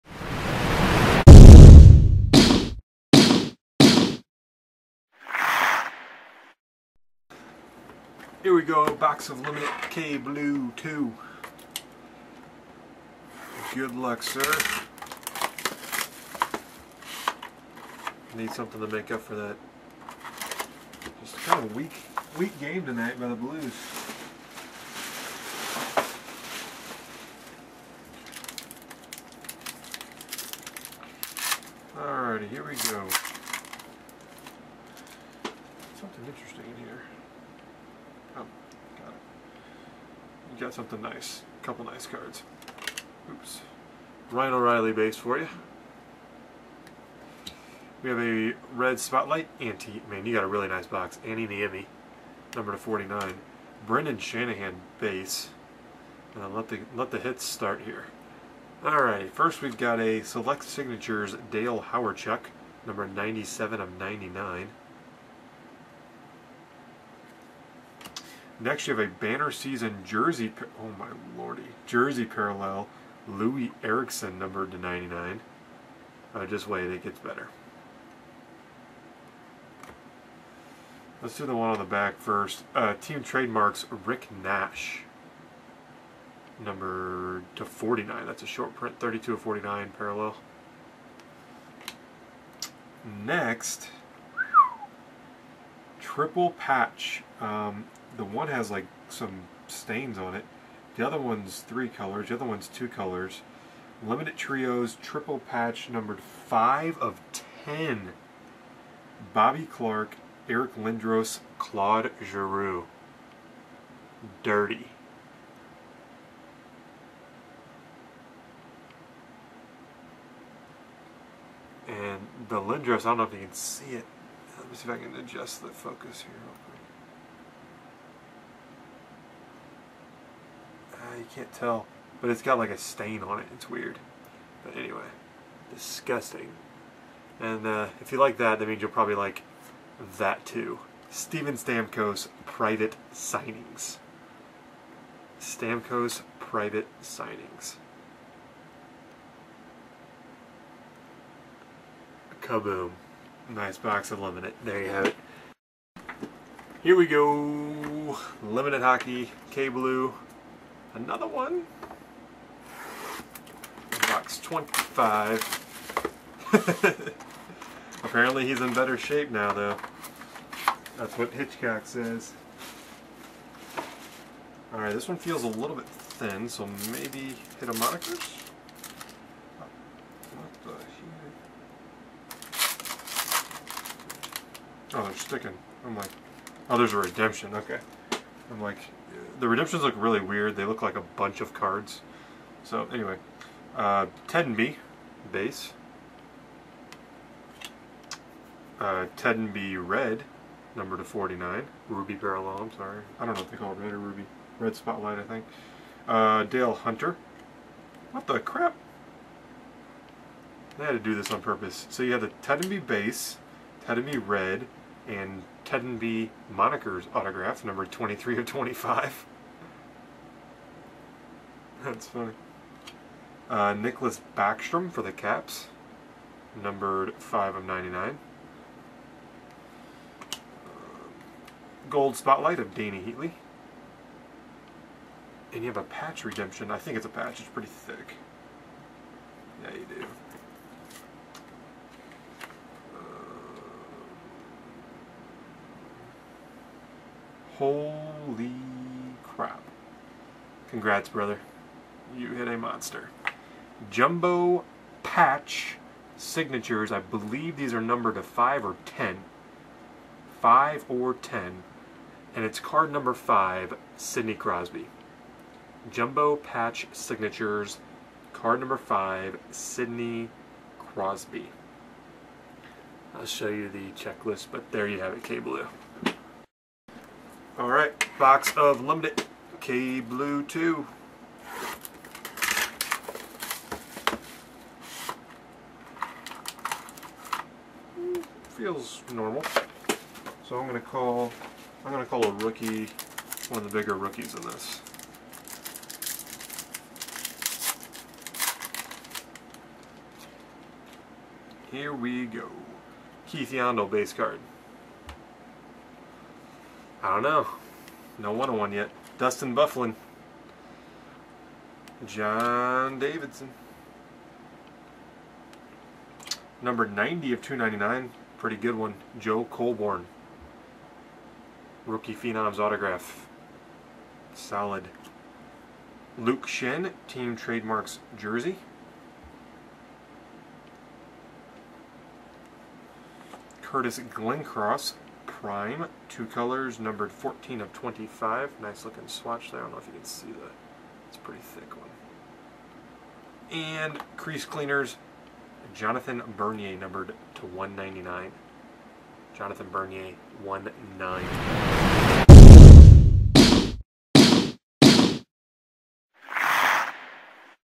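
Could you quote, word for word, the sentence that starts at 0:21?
Just kind of weak, weak game tonight by the Blues.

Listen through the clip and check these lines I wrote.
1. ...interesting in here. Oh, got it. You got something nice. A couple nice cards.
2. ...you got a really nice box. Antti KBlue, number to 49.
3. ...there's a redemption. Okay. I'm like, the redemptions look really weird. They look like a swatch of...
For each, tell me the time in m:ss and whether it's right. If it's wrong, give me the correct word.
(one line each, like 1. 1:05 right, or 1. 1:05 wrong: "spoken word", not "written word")
1. 0:36 right
2. 0:50 wrong: "Niemi", not "KBlue"
3. 3:06 wrong: "bunch", not "swatch".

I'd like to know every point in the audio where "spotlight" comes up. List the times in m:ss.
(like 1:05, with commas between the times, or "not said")
0:48, 3:24, 3:52.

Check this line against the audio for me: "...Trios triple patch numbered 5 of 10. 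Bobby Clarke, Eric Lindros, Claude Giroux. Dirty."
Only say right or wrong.
right.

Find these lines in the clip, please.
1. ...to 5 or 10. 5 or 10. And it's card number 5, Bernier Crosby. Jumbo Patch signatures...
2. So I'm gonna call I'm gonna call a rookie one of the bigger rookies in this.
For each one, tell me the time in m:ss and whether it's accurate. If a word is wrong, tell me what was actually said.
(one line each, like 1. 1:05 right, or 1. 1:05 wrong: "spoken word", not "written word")
1. 4:18 wrong: "Sidney", not "Bernier"
2. 4:50 right.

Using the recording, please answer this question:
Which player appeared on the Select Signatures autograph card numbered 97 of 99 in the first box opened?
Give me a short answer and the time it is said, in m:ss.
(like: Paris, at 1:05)
Dale Hawerchuk, at 1:01.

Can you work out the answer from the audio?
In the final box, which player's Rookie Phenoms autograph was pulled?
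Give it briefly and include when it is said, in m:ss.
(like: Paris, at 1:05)
Joe Colborne, at 5:19.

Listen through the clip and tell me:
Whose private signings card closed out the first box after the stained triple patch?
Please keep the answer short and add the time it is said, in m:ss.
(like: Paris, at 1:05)
Steven Stamkos, at 2:21.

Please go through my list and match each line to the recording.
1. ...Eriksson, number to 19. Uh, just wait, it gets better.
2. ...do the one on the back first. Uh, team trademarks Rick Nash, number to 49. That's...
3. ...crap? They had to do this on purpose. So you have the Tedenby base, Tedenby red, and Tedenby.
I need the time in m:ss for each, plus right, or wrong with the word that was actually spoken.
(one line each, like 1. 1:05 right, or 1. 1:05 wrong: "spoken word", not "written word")
1. 1:13 wrong: "99", not "19"
2. 1:21 right
3. 3:28 right.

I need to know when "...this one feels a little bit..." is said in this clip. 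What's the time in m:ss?
2:54.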